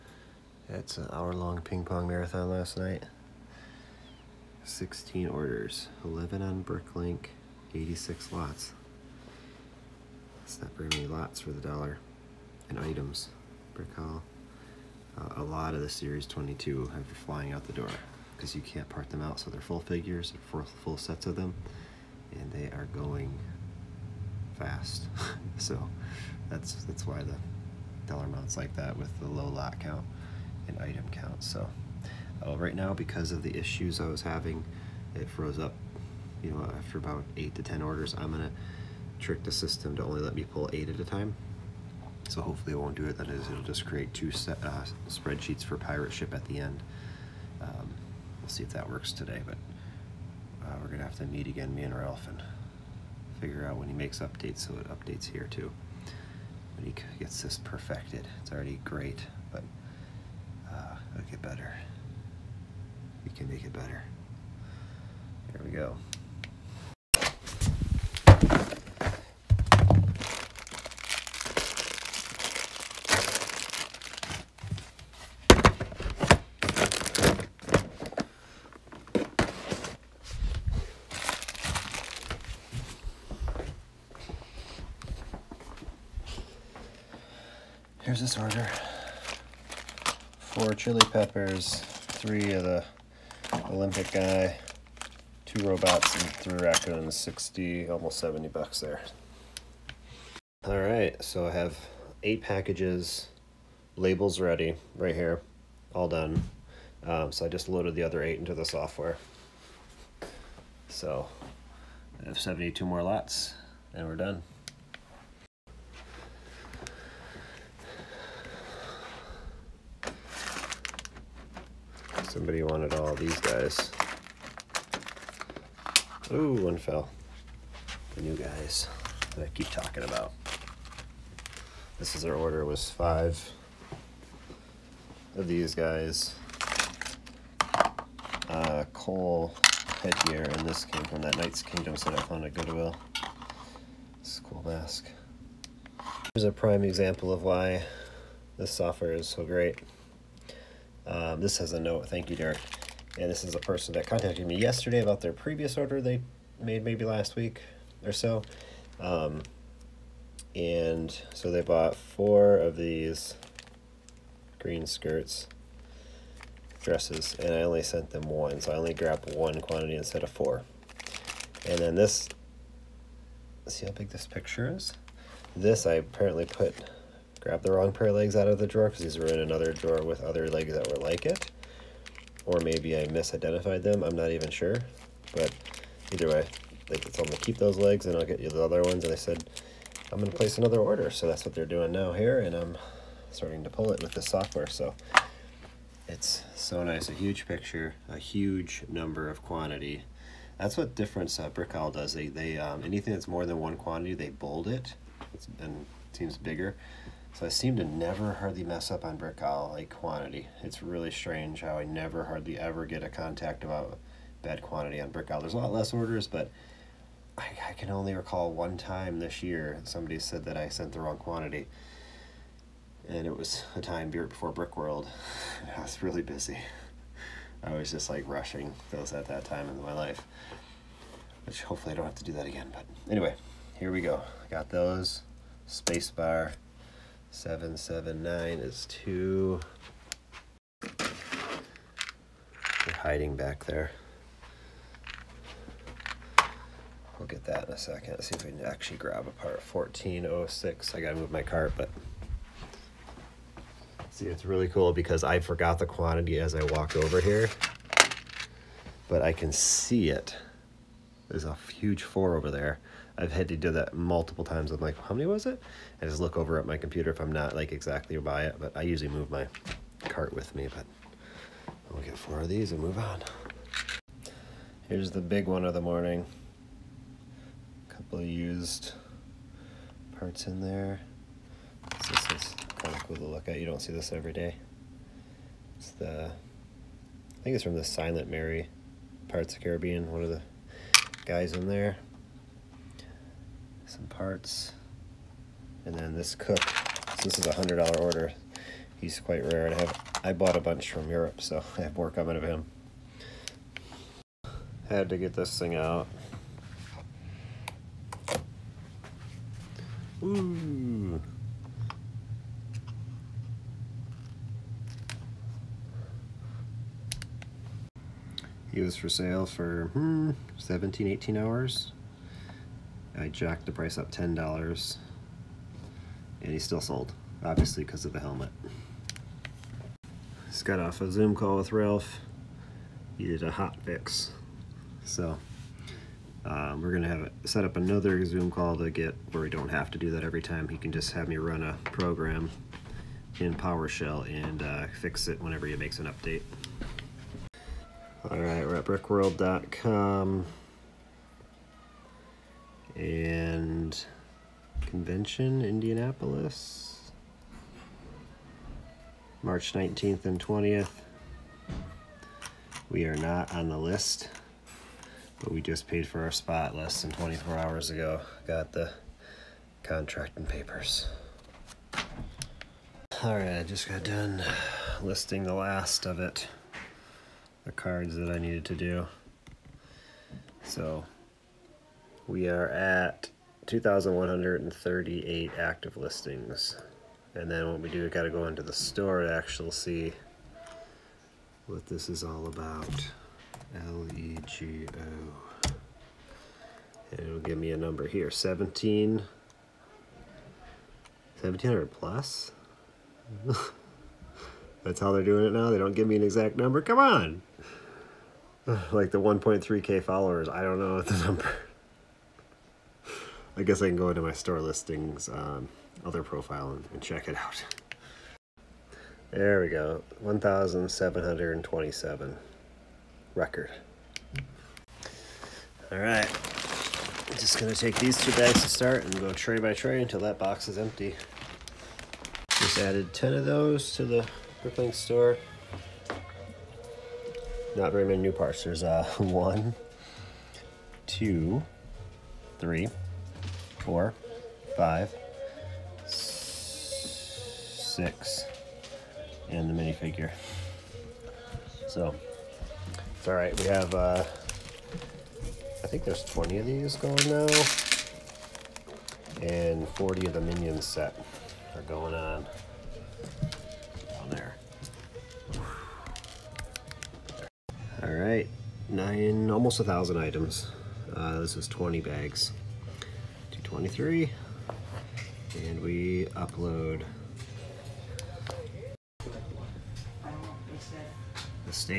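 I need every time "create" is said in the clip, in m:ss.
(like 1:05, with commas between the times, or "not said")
0:43.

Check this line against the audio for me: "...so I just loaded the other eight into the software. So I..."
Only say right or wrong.
right.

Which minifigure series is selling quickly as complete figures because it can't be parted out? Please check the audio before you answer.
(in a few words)
Series 22.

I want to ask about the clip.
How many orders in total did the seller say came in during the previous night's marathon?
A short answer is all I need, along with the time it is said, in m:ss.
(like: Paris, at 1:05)
16, at 0:04.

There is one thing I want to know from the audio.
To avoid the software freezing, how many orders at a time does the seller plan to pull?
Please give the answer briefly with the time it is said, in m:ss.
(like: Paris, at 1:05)
8, at 0:40.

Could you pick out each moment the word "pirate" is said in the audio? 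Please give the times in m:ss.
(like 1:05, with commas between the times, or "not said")
0:45, 4:49.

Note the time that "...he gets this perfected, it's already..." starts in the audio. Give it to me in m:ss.
0:56.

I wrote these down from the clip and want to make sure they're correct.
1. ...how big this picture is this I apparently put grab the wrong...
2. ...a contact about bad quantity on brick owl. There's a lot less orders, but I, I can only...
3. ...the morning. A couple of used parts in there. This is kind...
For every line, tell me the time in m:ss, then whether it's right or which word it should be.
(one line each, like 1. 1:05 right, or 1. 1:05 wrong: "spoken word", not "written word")
1. 2:53 right
2. 3:33 right
3. 4:35 right.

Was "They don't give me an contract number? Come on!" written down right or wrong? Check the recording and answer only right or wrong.
wrong.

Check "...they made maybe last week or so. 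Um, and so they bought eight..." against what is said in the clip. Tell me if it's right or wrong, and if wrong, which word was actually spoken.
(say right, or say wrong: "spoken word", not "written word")
wrong: "four", not "eight".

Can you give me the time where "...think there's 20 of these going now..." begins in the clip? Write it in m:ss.
7:35.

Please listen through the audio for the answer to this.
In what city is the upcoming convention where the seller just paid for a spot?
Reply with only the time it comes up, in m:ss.
5:55.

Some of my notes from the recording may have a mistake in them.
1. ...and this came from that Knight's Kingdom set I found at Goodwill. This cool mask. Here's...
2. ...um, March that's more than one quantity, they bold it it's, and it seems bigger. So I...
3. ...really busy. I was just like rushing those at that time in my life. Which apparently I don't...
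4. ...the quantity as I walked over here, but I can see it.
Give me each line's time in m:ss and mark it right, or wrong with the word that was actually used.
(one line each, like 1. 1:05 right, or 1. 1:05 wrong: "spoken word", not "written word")
1. 2:20 right
2. 3:22 wrong: "Anything", not "March"
3. 3:46 wrong: "hopefully", not "apparently"
4. 4:15 right.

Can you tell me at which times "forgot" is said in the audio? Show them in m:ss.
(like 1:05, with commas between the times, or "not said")
4:15.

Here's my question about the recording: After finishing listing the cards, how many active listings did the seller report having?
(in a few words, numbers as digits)
2,138.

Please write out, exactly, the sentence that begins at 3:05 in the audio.
But either way, they could tell to keep those legs and I'll get you the other ones.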